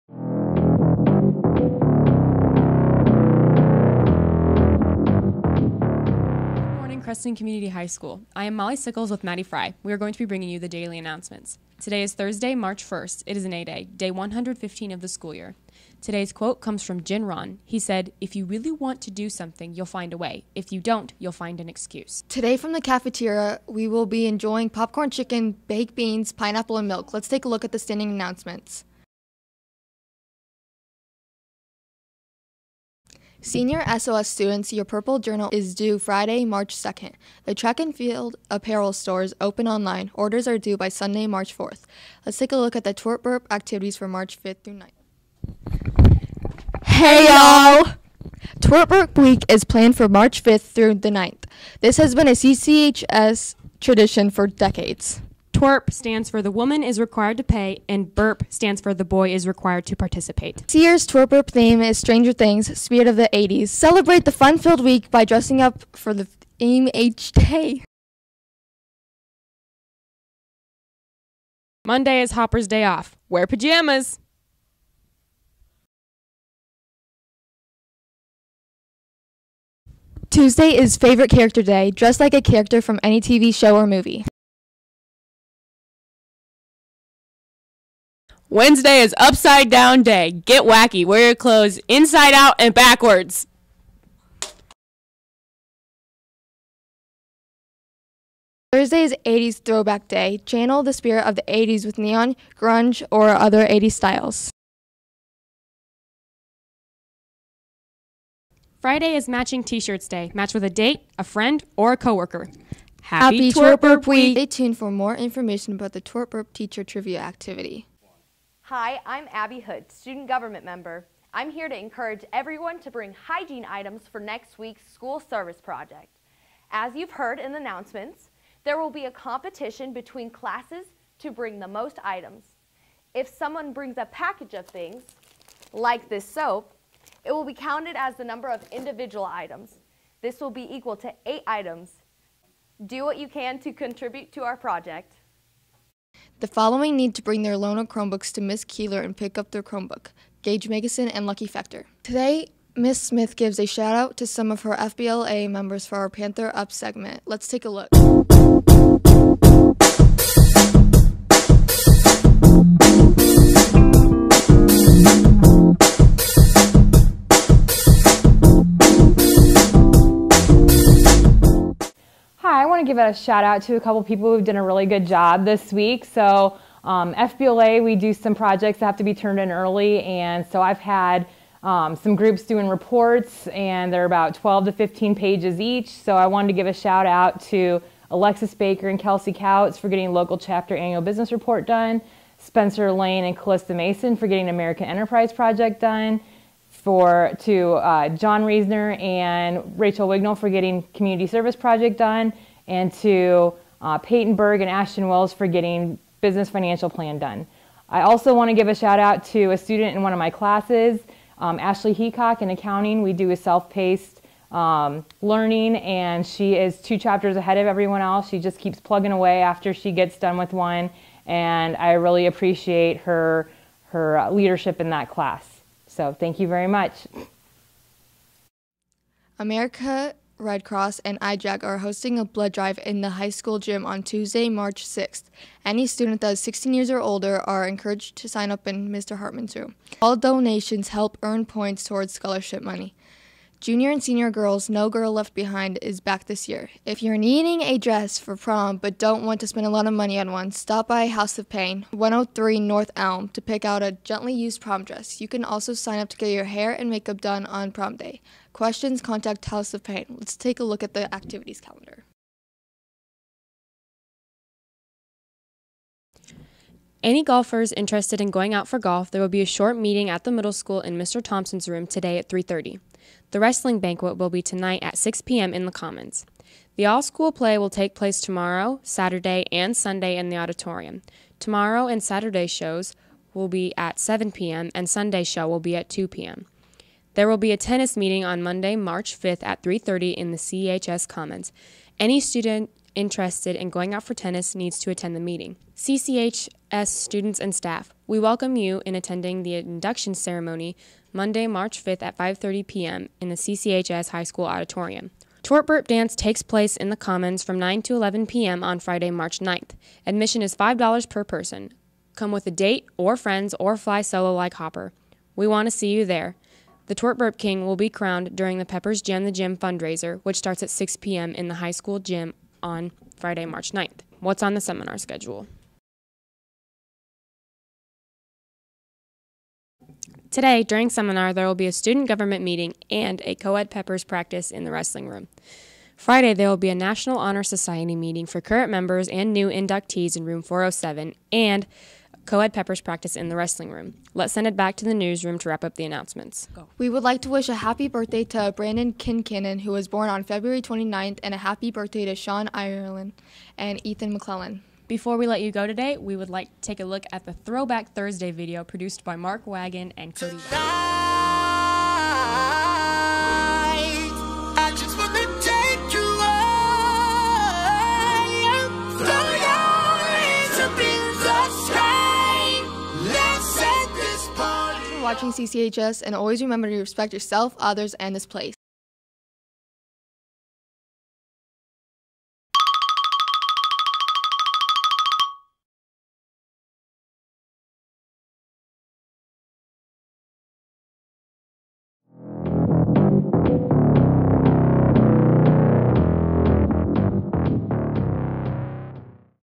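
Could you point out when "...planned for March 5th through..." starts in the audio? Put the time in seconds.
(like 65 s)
49 s.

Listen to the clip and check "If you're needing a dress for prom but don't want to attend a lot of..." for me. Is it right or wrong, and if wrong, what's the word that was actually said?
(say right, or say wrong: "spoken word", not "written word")
wrong: "spend", not "attend".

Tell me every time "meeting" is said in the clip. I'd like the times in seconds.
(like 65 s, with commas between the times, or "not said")
269 s, 287 s, 295 s, 332 s, 337 s.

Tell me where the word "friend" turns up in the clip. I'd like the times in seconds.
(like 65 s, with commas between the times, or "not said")
111 s, 313 s.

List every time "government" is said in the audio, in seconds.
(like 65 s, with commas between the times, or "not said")
120 s, 332 s.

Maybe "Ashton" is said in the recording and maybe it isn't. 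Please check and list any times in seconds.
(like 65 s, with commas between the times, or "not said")
204 s.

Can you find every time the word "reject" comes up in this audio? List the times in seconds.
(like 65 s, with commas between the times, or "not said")
not said.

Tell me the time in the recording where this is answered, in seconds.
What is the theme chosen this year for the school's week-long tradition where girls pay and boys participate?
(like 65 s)
61 s.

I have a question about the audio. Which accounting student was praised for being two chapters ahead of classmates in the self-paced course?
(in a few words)
Ashley Heacock.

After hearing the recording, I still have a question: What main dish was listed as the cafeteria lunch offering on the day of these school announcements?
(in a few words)
popcorn chicken.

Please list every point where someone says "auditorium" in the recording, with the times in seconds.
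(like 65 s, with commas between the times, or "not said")
280 s, 304 s.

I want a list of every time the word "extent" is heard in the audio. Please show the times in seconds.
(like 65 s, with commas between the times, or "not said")
not said.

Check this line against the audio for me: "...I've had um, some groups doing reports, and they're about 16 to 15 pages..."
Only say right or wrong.
wrong.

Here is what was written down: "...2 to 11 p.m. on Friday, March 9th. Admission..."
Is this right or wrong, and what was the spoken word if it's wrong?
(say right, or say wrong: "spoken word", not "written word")
wrong: "9", not "2".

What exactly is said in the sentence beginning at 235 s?
Any student that is 16 years or older are encouraged to sign up in Mr.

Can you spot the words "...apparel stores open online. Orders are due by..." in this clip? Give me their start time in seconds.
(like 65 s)
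38 s.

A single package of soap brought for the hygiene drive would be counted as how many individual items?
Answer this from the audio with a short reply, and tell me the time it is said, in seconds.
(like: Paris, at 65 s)
8, at 141 s.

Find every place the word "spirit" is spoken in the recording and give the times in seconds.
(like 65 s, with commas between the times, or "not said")
62 s, 100 s.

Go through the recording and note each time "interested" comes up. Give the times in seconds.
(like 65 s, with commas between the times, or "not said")
267 s, 292 s.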